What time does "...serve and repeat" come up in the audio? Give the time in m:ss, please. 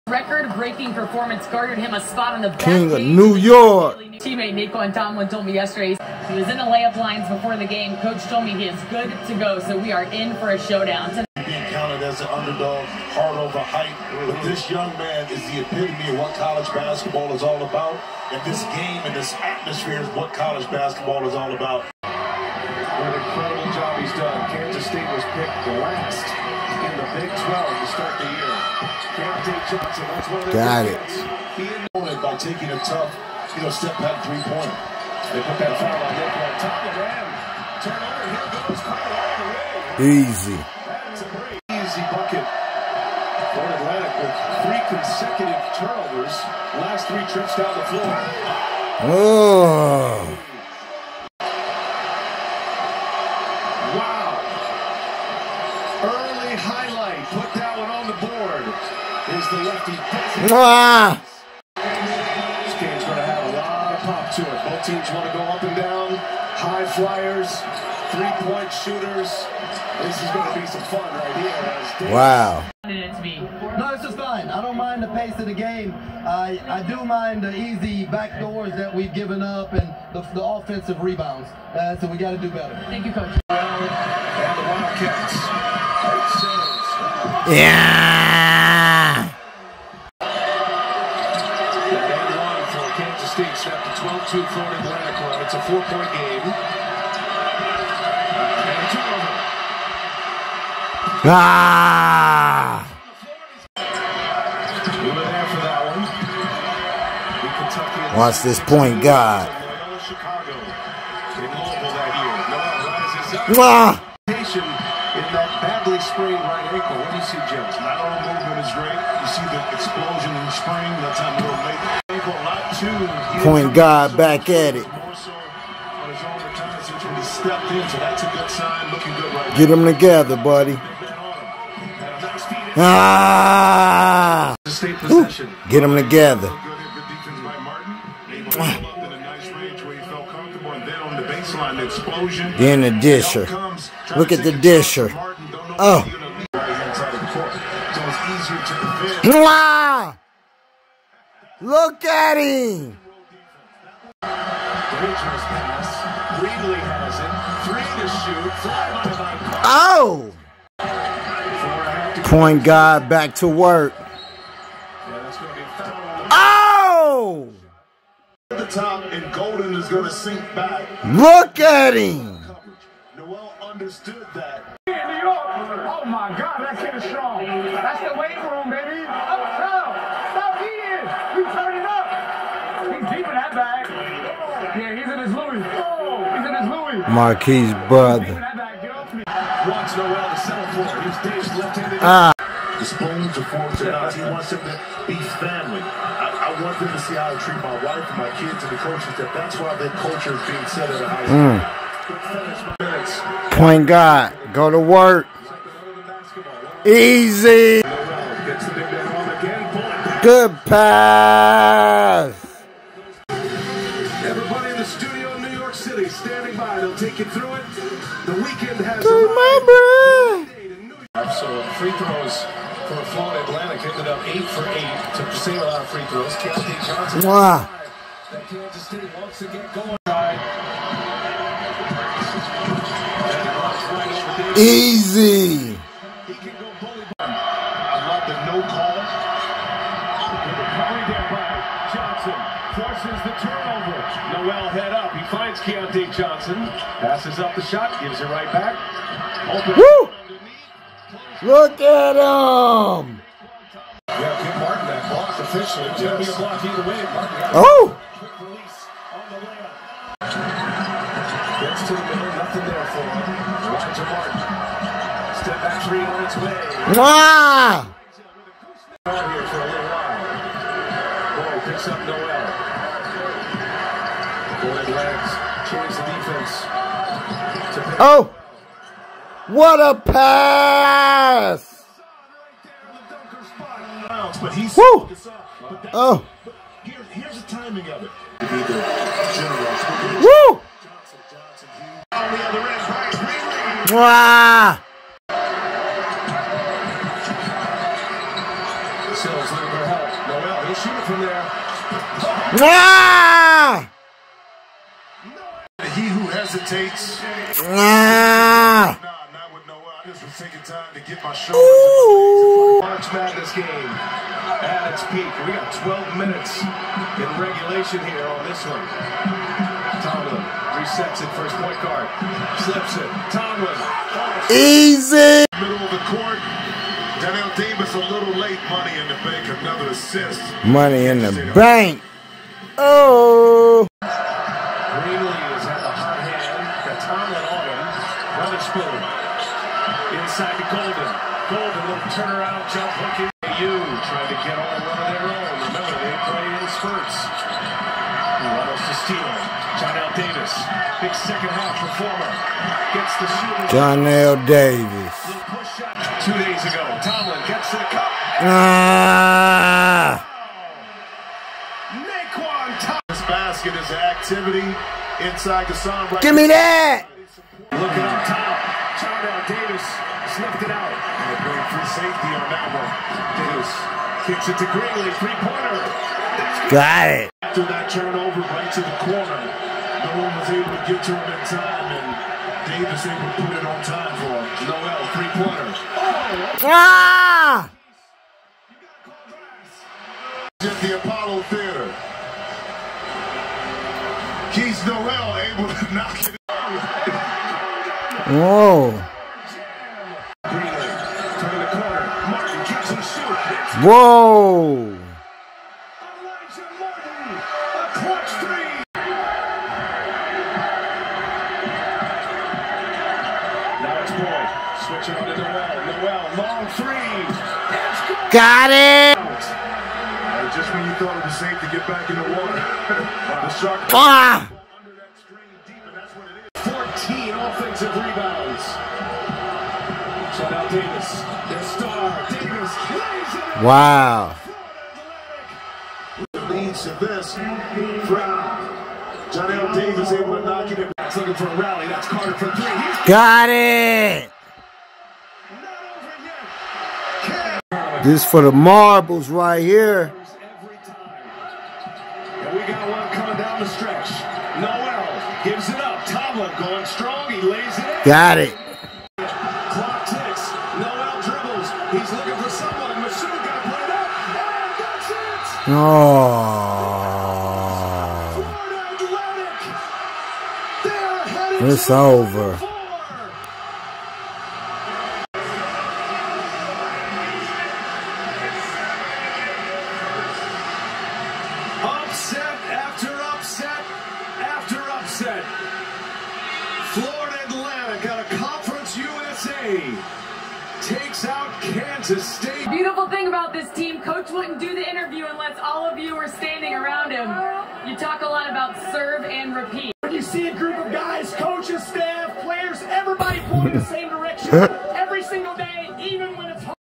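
8:18.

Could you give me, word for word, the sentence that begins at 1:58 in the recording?
You see the explosion in the spring.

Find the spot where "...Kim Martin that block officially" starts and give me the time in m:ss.
4:14.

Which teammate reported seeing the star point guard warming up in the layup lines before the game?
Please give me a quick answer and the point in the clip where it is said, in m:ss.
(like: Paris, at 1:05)
Nae'Qwan Tomlin, at 0:04.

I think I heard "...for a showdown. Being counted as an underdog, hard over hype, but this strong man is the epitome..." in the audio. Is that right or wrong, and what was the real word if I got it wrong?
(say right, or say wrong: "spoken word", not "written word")
wrong: "young", not "strong".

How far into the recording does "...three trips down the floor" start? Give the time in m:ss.
0:47.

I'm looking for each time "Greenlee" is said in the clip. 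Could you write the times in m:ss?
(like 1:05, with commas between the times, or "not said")
5:34, 6:14.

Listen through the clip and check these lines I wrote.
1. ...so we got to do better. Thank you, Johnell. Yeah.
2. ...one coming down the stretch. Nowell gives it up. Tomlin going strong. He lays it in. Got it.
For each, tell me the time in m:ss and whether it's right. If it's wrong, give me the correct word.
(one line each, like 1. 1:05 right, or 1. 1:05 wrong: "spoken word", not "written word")
1. 1:21 wrong: "Coach", not "Johnell"
2. 7:32 right.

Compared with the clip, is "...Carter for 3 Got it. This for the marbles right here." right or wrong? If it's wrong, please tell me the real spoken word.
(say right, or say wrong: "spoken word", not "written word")
right.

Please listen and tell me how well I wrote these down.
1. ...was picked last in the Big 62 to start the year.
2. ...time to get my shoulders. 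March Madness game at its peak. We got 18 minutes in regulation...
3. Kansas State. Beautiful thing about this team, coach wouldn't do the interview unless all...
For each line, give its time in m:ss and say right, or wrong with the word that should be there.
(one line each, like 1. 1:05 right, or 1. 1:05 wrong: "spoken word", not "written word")
1. 0:25 wrong: "12", not "62"
2. 5:10 wrong: "12", not "18"
3. 8:12 right.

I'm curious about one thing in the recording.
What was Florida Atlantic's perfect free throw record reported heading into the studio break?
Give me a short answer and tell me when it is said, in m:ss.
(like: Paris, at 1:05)
8 for 8, at 3:44.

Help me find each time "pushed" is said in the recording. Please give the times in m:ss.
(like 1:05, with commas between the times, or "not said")
not said.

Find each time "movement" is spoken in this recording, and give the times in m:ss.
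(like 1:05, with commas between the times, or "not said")
1:58.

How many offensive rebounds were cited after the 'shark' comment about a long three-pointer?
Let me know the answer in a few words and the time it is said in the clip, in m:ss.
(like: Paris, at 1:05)
14, at 7:07.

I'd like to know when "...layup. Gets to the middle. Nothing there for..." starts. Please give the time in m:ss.
4:19.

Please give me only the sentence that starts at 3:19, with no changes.
That that's why that culture is being set at a high school.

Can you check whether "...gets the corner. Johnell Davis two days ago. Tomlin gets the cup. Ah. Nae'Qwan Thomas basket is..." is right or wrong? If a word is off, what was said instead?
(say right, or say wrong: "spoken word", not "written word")
wrong: "shooter", not "corner".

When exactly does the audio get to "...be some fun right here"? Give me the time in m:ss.
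1:10.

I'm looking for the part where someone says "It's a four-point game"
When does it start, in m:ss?
1:35.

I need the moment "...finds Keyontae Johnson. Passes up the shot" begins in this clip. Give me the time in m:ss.
4:05.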